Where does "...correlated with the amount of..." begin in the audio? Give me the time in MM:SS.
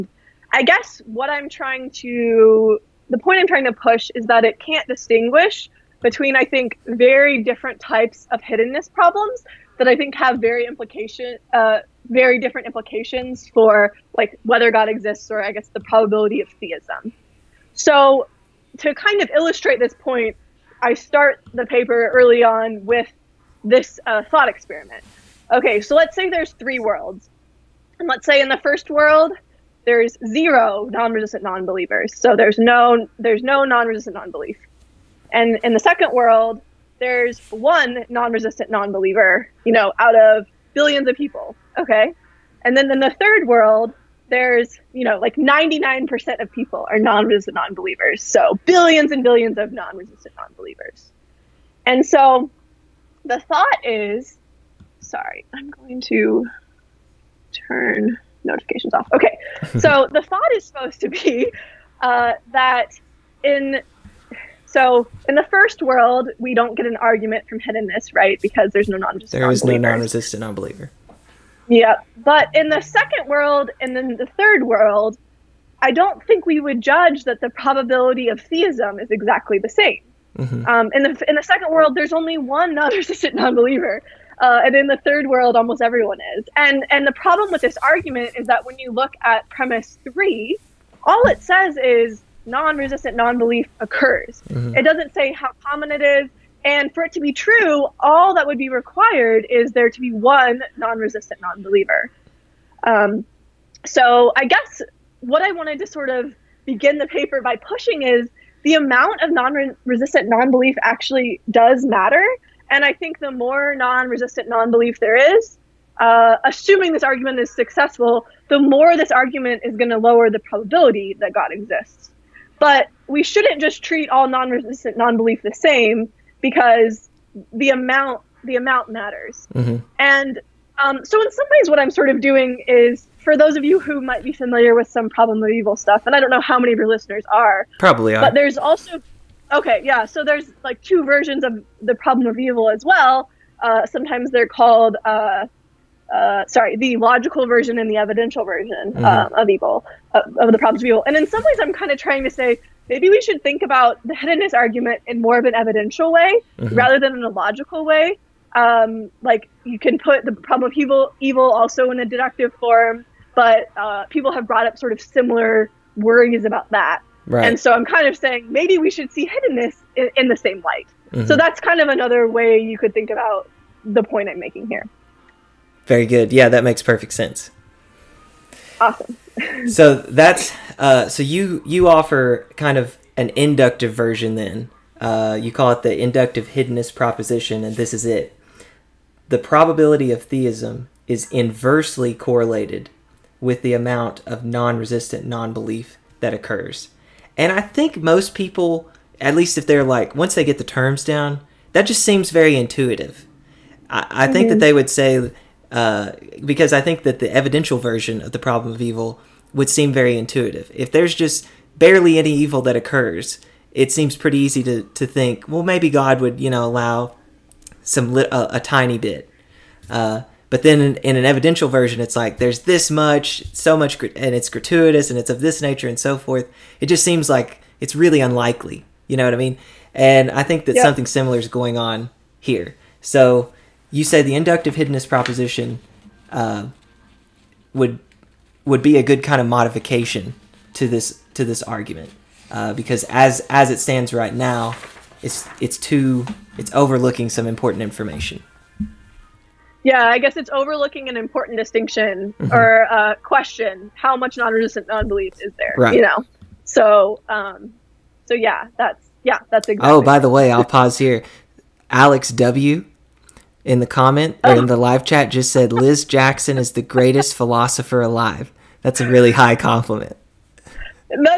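03:12.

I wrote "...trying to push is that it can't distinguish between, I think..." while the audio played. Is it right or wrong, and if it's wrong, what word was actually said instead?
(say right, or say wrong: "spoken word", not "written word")
right.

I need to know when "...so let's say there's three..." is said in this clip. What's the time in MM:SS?
00:25.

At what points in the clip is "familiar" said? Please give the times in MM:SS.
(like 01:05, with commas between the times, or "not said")
02:14.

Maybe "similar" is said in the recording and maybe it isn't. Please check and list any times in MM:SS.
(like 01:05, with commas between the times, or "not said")
02:44, 03:51.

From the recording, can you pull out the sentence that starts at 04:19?
Oh, by the way, I'll pause here.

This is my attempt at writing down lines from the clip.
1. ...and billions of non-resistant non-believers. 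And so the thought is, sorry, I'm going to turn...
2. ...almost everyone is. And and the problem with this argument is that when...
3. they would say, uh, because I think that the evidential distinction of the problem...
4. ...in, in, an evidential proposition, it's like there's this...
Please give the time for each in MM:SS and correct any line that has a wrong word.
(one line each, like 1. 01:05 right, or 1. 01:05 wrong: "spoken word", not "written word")
1. 00:49 right
2. 01:25 right
3. 03:24 wrong: "version", not "distinction"
4. 03:40 wrong: "version", not "proposition".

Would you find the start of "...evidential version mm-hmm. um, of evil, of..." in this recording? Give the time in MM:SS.
02:27.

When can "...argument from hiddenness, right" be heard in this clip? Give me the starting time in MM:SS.
01:06.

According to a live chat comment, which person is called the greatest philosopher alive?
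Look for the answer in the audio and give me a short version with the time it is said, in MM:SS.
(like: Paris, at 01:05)
Liz Jackson, at 04:25.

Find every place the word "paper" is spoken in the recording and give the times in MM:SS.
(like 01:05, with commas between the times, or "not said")
00:21, 01:47.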